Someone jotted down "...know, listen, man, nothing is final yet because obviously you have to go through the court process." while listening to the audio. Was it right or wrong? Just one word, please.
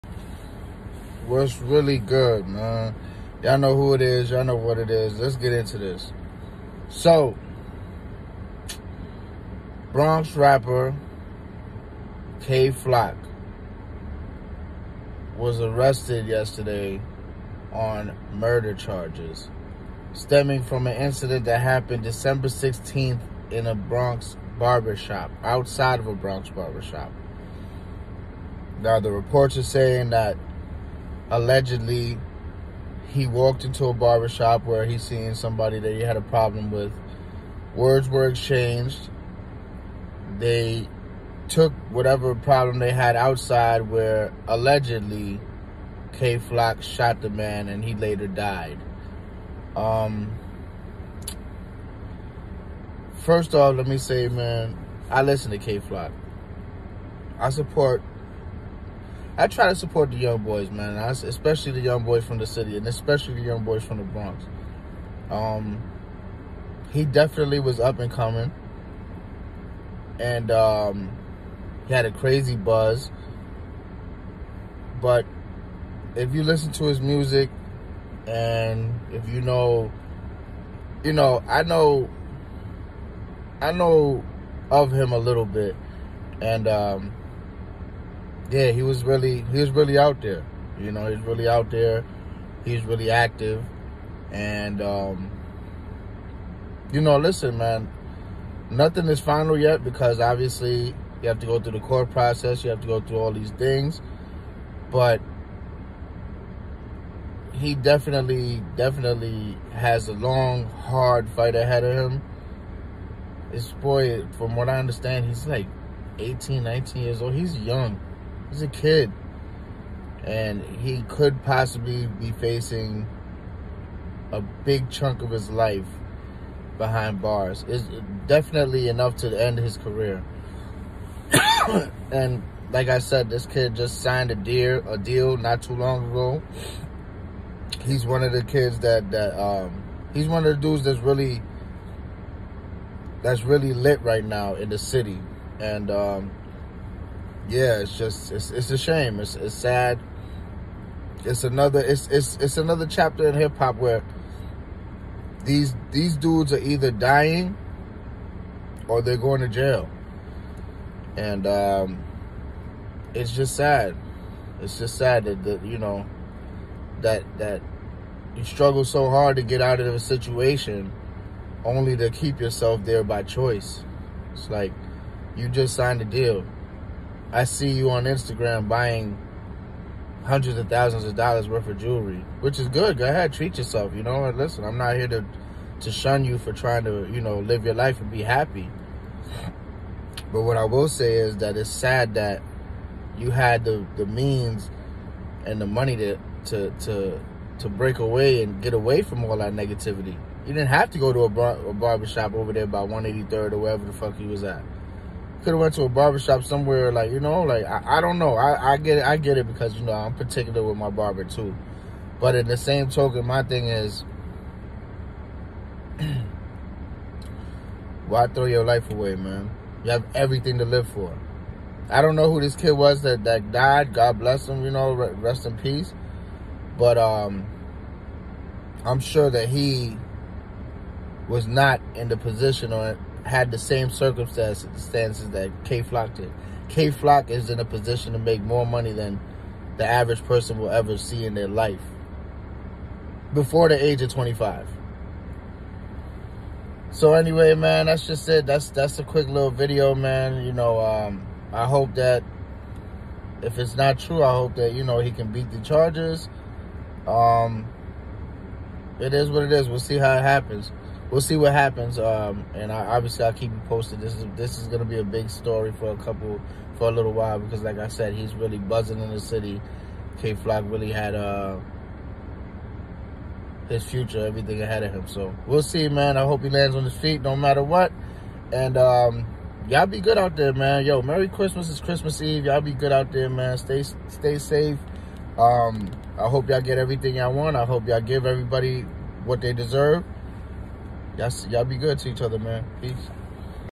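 right.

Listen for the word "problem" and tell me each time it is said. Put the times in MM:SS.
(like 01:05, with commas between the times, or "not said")
00:36, 00:42.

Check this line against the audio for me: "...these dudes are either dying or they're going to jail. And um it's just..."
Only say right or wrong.
right.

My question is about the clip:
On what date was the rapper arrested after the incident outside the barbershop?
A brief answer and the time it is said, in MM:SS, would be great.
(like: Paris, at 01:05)
December 16th, at 00:22.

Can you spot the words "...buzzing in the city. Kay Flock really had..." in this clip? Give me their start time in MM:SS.
04:28.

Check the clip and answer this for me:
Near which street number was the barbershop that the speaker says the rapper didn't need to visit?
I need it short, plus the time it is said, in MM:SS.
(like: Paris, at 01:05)
183rd, at 03:22.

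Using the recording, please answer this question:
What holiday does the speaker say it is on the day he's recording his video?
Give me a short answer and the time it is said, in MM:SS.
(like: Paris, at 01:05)
Christmas Eve, at 04:41.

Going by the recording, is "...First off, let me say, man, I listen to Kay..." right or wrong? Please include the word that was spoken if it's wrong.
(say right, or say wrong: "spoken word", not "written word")
right.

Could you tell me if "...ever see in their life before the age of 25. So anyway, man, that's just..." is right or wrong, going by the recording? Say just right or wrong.
right.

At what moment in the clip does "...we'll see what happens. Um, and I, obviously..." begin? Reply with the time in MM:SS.
04:21.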